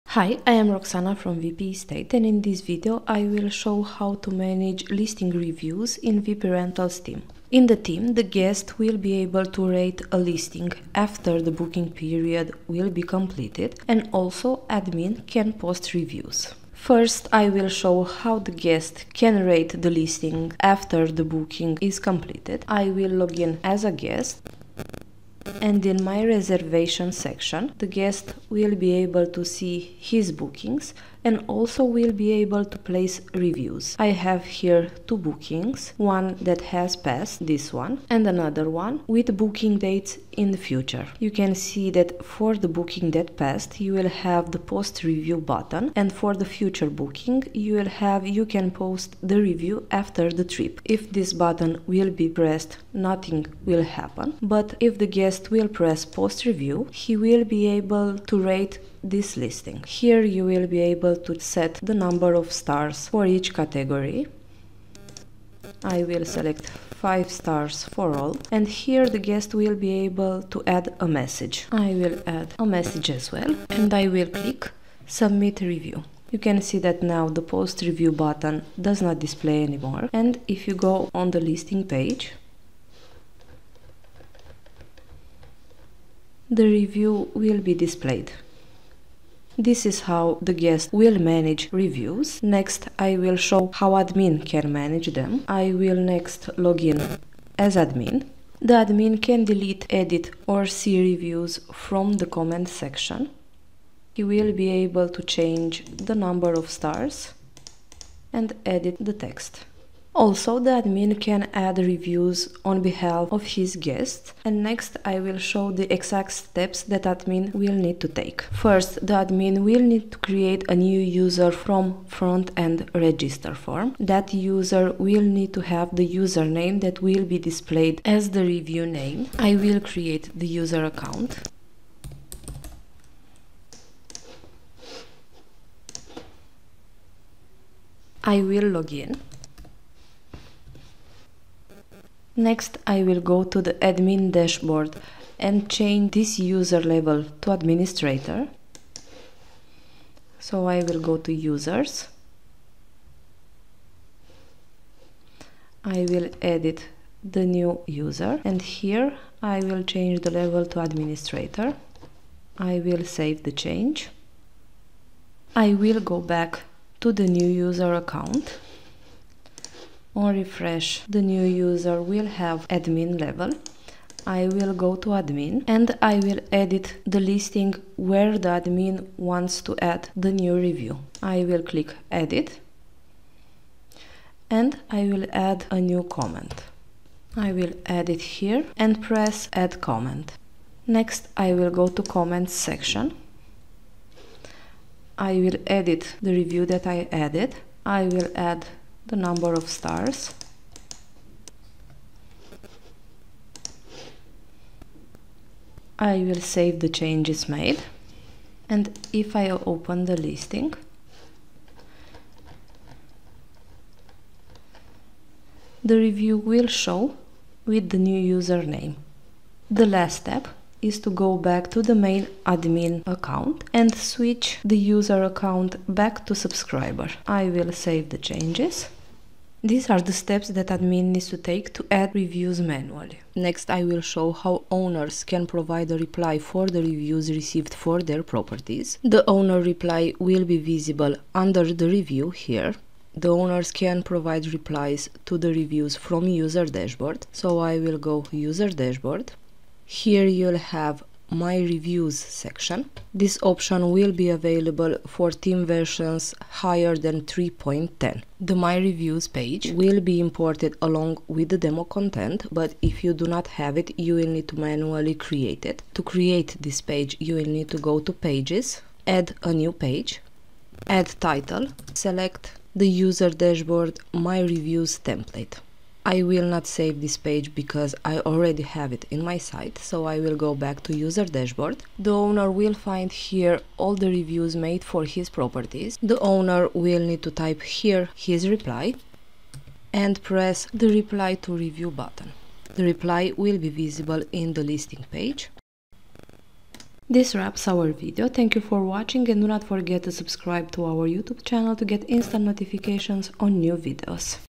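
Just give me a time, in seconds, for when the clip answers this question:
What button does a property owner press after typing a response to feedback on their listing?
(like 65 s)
290 s.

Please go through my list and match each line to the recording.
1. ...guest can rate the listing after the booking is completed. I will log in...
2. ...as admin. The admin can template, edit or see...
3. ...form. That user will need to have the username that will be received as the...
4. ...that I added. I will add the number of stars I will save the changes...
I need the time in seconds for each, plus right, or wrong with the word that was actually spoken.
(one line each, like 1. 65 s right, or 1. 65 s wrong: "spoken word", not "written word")
1. 18 s right
2. 97 s wrong: "delete", not "template"
3. 123 s wrong: "displayed", not "received"
4. 196 s right.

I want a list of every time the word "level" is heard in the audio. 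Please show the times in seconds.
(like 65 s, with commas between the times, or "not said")
160 s, 173 s.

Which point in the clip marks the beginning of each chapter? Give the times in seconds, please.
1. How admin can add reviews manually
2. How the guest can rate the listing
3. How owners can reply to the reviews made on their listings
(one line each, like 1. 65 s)
1. 92 s
2. 18 s
3. 235 s.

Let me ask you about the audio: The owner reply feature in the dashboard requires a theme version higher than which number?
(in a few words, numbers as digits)
3.10.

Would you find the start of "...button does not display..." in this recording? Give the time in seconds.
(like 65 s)
78 s.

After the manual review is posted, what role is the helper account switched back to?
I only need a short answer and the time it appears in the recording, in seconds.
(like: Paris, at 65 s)
subscriber, at 226 s.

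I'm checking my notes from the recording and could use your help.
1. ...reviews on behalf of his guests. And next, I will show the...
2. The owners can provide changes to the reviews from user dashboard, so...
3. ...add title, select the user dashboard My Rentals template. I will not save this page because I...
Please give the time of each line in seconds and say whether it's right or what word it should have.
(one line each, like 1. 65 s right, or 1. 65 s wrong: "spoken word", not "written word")
1. 111 s right
2. 243 s wrong: "replies", not "changes"
3. 270 s wrong: "Reviews", not "Rentals".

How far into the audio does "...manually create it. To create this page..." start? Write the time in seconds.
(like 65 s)
264 s.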